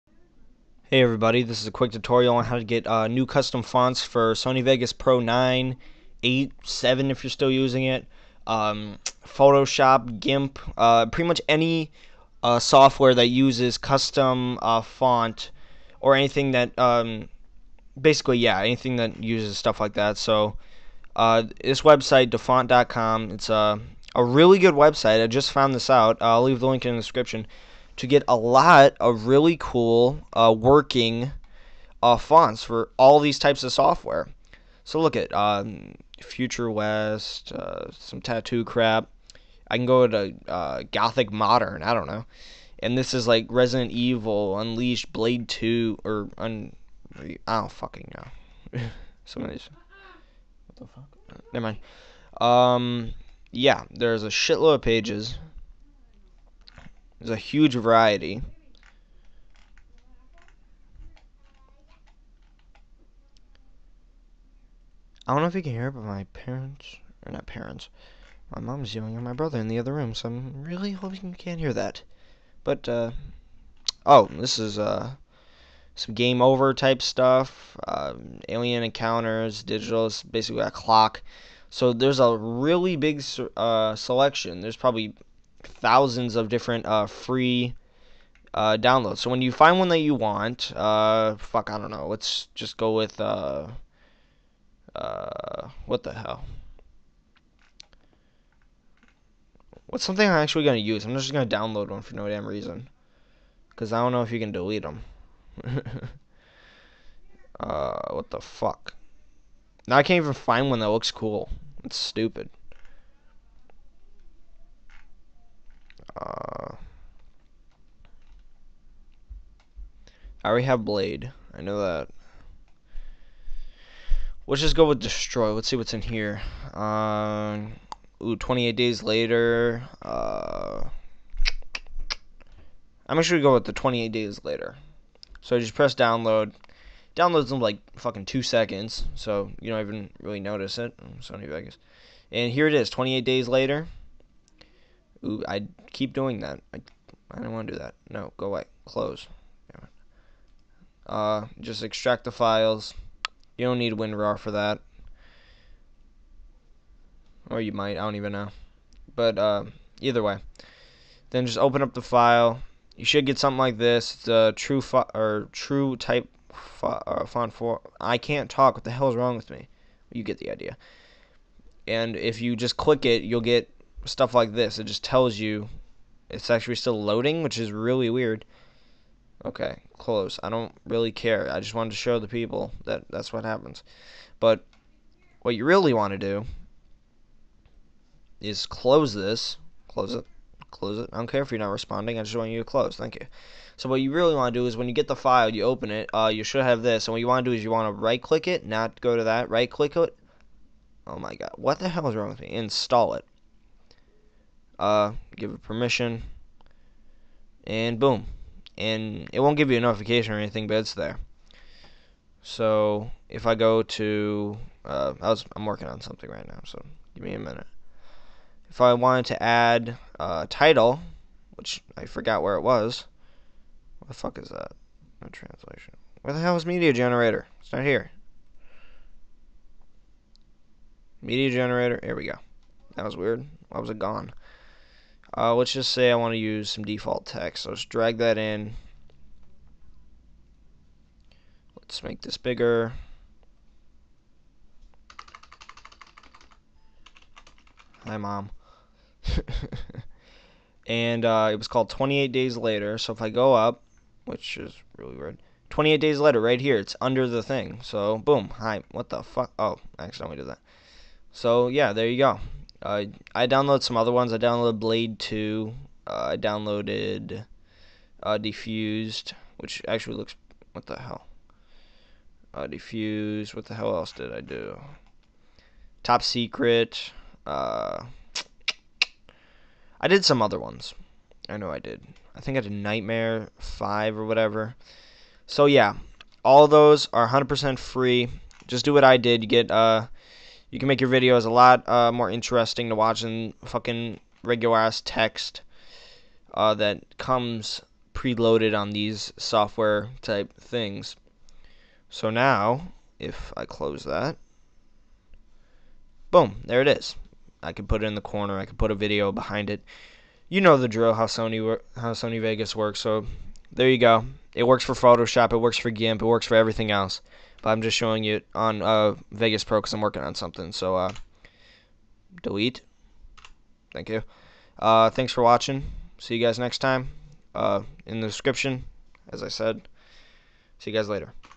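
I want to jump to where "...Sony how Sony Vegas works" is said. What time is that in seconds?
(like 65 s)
311 s.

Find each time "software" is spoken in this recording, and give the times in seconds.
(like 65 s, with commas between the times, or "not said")
12 s, 33 s, 299 s.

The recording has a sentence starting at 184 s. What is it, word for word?
But what you really want to do is close this.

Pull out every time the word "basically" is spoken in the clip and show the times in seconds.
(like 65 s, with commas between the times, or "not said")
18 s, 80 s.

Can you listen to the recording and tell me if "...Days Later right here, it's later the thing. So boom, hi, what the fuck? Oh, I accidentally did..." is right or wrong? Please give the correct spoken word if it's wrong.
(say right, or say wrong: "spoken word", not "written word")
wrong: "under", not "later".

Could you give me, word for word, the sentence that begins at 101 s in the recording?
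I'm just gonna download one for no damn reason, cause I don't know if you can delete them.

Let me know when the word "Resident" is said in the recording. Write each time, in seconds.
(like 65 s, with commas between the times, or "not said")
43 s.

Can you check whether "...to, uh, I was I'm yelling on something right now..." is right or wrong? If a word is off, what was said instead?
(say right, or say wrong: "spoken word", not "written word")
wrong: "working", not "yelling".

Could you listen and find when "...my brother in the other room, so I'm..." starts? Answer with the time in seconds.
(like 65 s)
69 s.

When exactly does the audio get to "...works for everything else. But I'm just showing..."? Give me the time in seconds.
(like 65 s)
316 s.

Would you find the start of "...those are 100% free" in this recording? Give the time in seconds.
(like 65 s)
286 s.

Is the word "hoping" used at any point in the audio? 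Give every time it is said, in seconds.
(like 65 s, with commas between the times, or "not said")
70 s.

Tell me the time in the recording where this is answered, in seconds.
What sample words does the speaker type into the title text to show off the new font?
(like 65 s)
248 s.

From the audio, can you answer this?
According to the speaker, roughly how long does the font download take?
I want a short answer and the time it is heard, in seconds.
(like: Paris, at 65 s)
two seconds, at 138 s.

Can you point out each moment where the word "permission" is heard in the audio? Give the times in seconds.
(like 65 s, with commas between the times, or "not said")
205 s.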